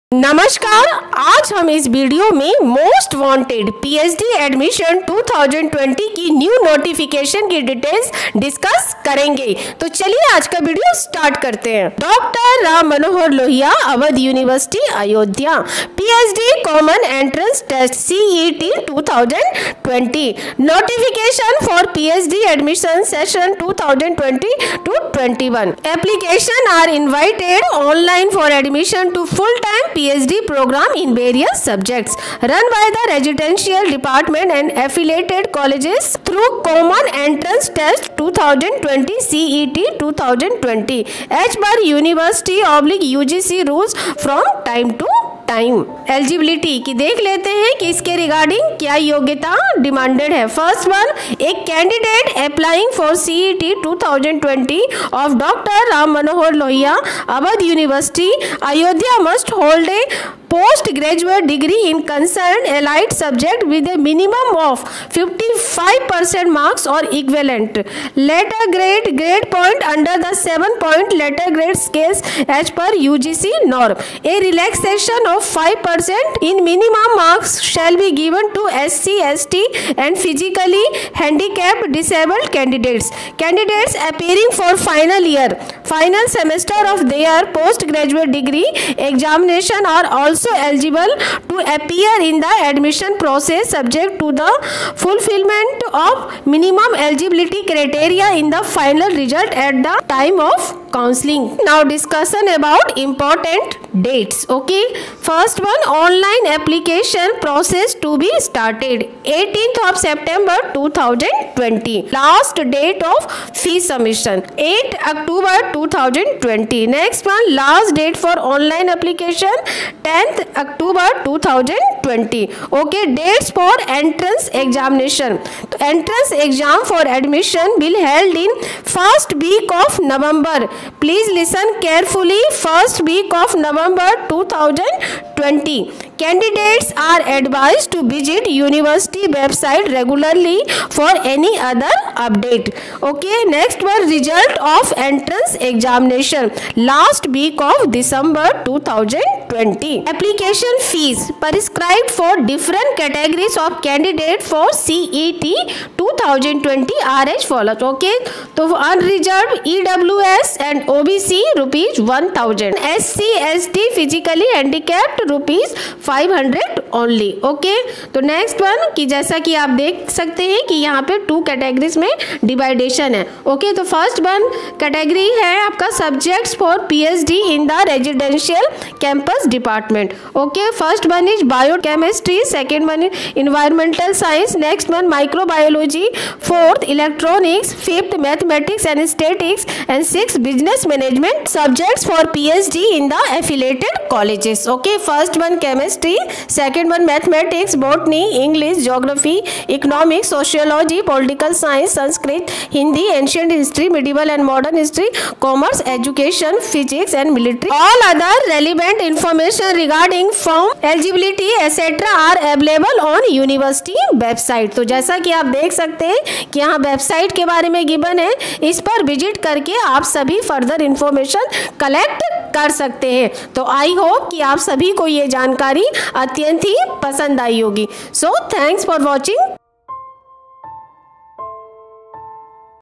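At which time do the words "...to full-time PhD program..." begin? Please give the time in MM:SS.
00:29.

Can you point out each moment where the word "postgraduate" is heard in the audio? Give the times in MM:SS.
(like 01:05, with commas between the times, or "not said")
01:00, 01:27.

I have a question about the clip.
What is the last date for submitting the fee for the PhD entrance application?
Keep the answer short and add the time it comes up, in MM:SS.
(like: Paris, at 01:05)
8 October 2020, at 01:54.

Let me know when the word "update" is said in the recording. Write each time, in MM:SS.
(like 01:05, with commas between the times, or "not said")
02:22.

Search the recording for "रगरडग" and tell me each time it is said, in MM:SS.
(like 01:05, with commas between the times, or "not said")
00:48, 03:29.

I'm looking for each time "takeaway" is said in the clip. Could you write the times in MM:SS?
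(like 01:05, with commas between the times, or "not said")
not said.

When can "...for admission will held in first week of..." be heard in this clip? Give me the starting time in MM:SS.
02:06.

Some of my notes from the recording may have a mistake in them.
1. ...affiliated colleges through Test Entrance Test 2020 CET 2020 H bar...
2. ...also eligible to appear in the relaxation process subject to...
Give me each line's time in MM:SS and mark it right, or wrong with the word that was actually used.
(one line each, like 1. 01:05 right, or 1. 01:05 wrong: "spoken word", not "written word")
1. 00:34 wrong: "Common", not "Test"
2. 01:30 wrong: "admission", not "relaxation".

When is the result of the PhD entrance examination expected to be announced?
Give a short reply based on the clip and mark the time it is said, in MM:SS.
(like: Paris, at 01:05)
Last week of December 2020, at 02:26.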